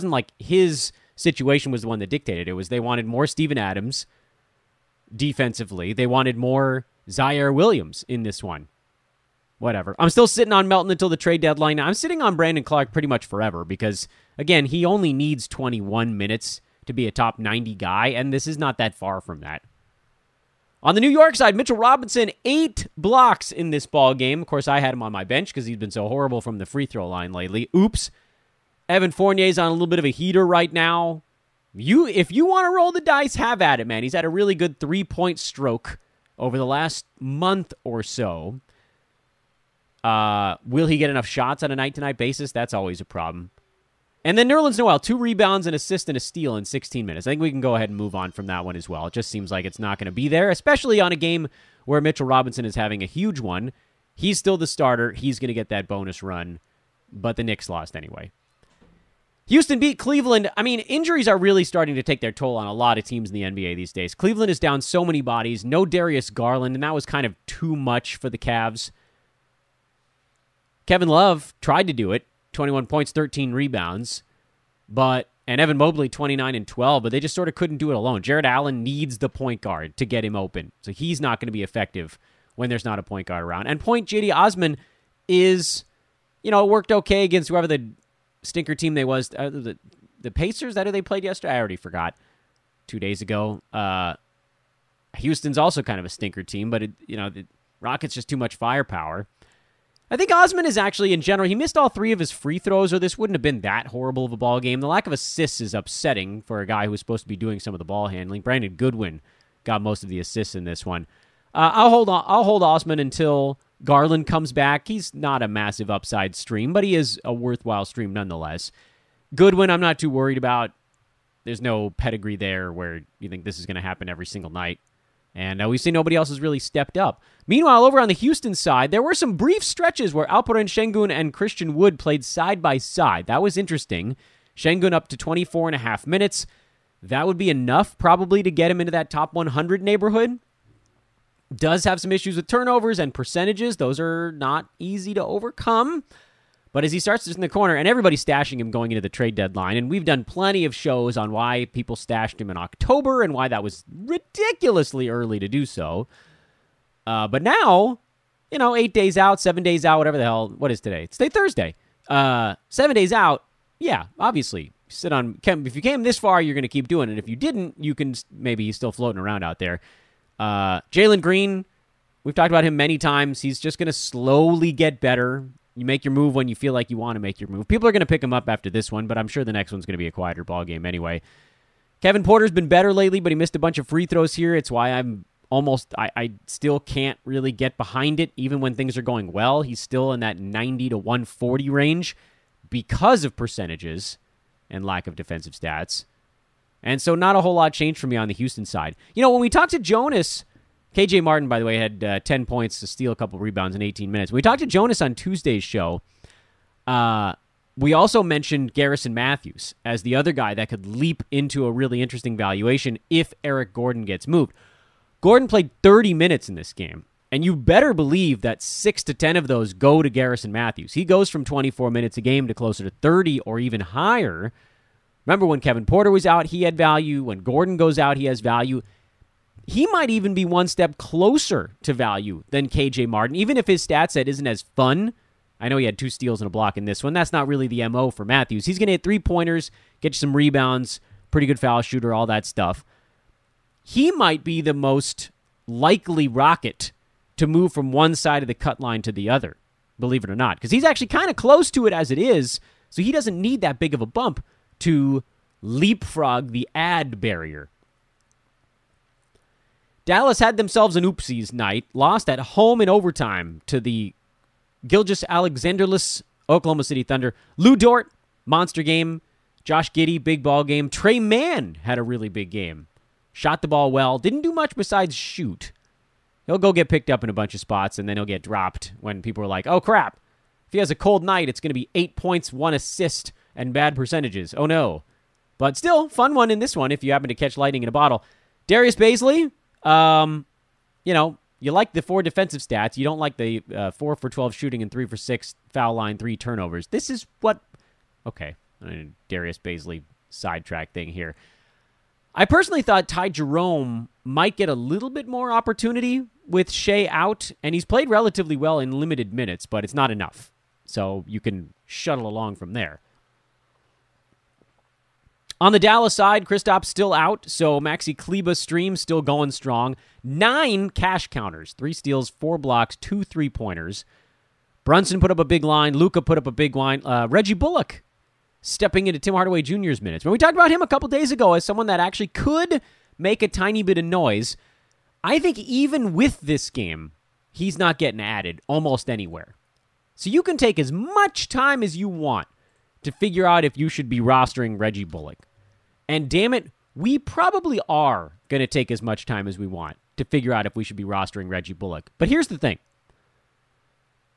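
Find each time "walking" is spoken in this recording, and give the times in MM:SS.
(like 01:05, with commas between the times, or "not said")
not said.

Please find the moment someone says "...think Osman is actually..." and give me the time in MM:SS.
01:40.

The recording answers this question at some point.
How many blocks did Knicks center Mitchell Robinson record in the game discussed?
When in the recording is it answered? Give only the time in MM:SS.
00:22.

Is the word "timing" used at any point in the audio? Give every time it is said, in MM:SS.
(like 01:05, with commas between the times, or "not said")
not said.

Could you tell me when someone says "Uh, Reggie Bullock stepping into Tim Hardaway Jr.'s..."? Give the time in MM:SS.
05:27.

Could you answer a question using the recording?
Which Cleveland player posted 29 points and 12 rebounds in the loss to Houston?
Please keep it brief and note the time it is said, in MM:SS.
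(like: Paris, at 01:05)
Evan Mobley, at 01:15.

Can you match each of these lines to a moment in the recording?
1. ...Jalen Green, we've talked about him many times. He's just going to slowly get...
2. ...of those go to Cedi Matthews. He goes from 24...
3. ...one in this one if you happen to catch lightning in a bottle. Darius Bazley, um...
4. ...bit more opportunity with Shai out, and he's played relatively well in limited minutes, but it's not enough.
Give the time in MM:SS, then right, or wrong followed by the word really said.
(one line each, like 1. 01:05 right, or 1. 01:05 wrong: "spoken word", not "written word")
1. 02:50 right
2. 03:39 wrong: "Garrison", not "Cedi"
3. 04:46 right
4. 05:05 right.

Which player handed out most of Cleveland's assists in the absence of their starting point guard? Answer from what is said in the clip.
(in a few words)
Brandon Goodwin.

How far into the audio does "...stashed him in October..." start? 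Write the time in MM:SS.
02:31.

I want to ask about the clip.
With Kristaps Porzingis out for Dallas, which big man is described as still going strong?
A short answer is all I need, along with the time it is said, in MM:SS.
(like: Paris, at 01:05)
Maxi Kleber, at 05:17.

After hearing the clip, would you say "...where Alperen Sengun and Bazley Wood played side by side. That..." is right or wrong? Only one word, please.
wrong.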